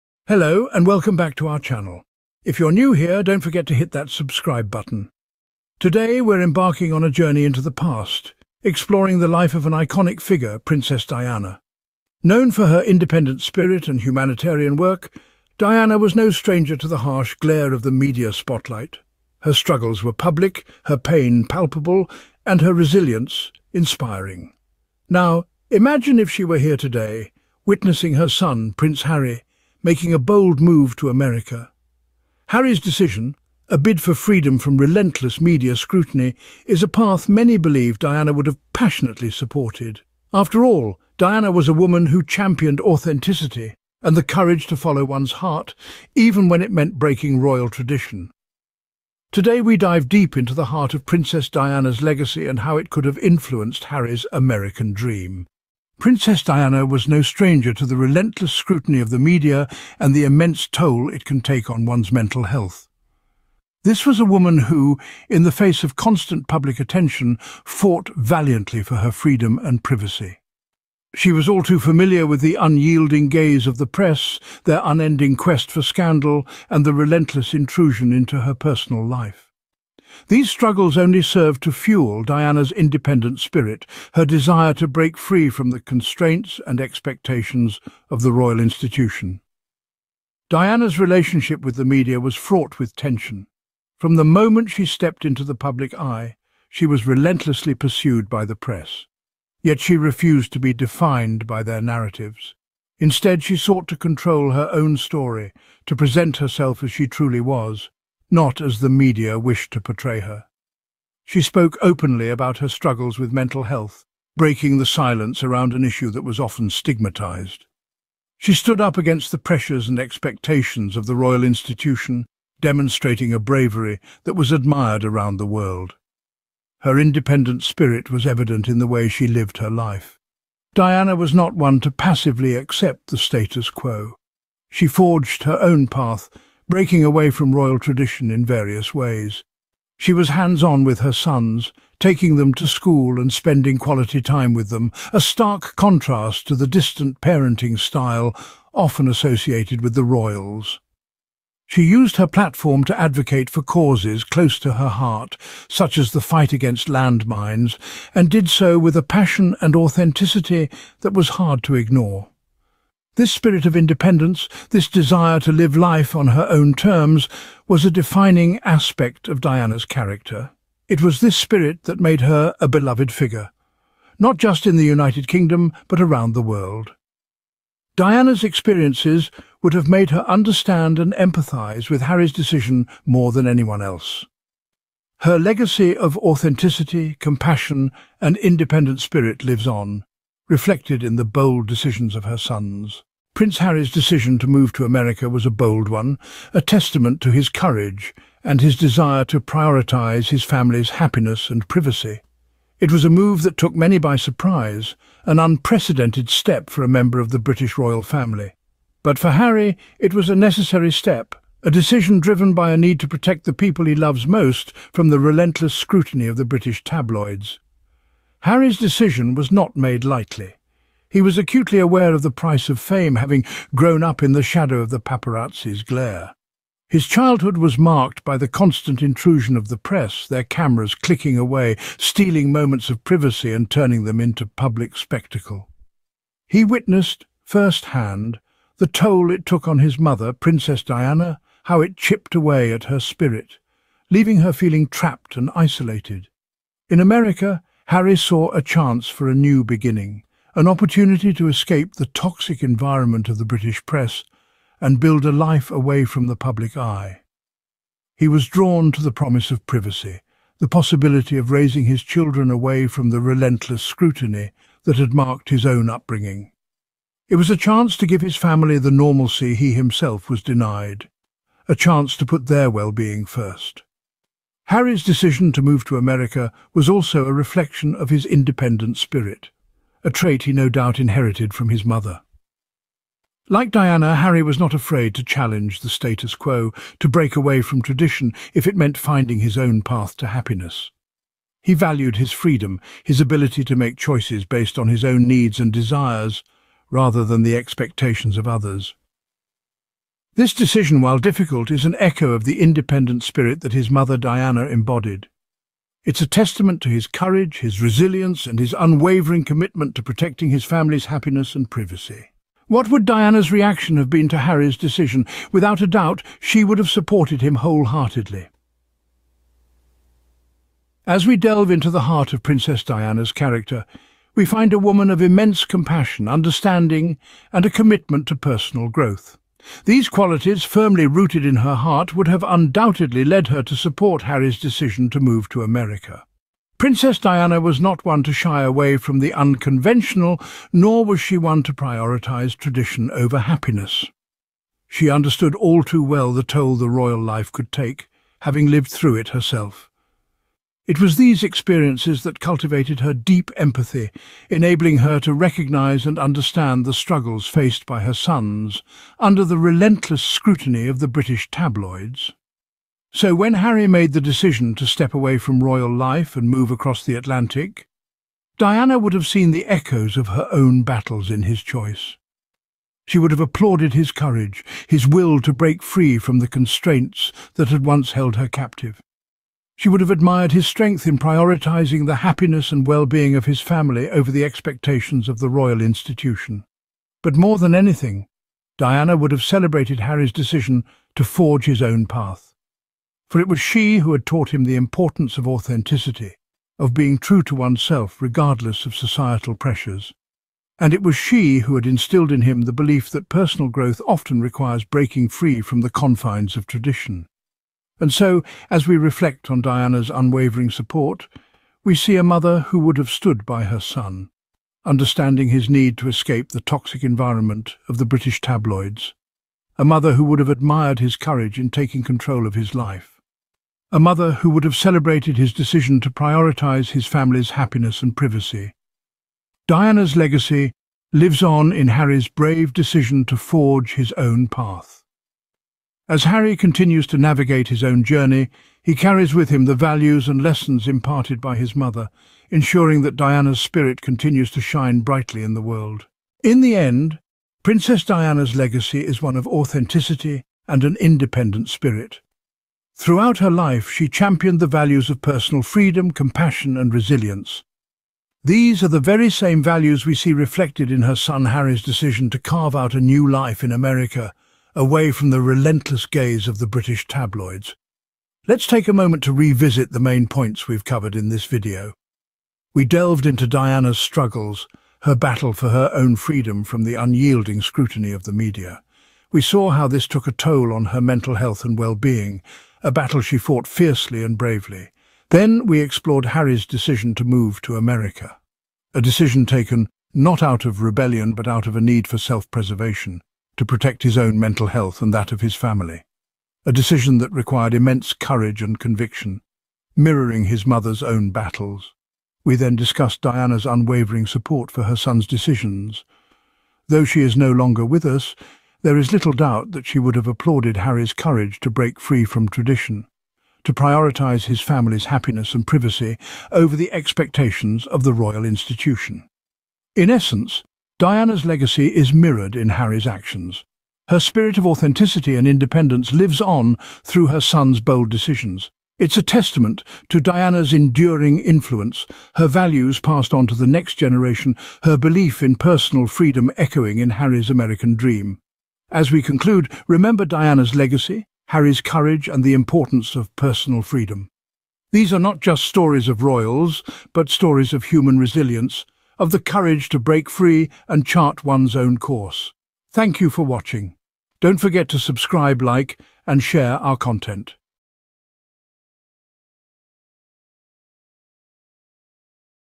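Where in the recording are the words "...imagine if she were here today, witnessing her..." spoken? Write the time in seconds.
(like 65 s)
25 s.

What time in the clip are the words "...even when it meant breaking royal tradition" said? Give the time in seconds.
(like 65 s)
46 s.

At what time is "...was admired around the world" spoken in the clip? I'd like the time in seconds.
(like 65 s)
124 s.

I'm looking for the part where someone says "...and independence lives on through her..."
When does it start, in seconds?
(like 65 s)
525 s.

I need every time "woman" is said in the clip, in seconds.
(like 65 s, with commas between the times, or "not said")
41 s, 64 s, 324 s.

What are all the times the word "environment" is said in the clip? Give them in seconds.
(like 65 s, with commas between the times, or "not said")
252 s, 417 s.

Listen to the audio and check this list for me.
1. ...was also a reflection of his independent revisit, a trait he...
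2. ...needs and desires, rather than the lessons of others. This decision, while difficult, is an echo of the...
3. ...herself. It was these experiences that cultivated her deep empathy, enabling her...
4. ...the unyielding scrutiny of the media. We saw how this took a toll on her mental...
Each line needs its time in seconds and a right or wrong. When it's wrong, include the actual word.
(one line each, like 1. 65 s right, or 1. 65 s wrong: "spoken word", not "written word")
1. 276 s wrong: "spirit", not "revisit"
2. 295 s wrong: "expectations", not "lessons"
3. 349 s right
4. 476 s right.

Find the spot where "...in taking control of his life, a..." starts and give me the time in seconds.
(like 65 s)
421 s.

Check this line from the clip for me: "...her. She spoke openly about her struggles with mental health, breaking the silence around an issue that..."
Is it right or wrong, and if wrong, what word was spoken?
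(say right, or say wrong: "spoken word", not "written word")
right.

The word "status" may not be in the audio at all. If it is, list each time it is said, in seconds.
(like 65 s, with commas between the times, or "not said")
133 s, 285 s.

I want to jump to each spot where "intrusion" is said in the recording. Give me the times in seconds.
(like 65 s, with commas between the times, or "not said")
77 s, 229 s.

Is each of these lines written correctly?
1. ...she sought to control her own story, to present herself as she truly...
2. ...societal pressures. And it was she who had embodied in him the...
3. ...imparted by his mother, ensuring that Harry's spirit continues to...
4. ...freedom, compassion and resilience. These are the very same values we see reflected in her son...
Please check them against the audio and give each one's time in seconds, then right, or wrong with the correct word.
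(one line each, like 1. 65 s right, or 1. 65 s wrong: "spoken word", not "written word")
1. 103 s right
2. 398 s wrong: "instilled", not "embodied"
3. 440 s wrong: "Diana", not "Harry"
4. 455 s right.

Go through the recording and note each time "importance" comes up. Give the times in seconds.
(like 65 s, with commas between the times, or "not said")
394 s, 542 s.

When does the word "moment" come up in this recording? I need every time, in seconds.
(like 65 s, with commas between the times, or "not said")
94 s, 232 s, 468 s.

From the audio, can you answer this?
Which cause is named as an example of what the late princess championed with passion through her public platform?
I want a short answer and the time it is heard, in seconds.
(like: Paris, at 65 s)
Landmines, at 156 s.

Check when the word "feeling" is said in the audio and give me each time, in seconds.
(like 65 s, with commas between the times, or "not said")
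244 s.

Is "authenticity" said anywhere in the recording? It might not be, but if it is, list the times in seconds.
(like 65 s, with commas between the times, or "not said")
42 s, 159 s, 186 s, 395 s, 449 s, 524 s.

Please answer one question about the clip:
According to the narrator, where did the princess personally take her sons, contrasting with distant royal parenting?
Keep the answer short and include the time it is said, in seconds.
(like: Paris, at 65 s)
School, at 142 s.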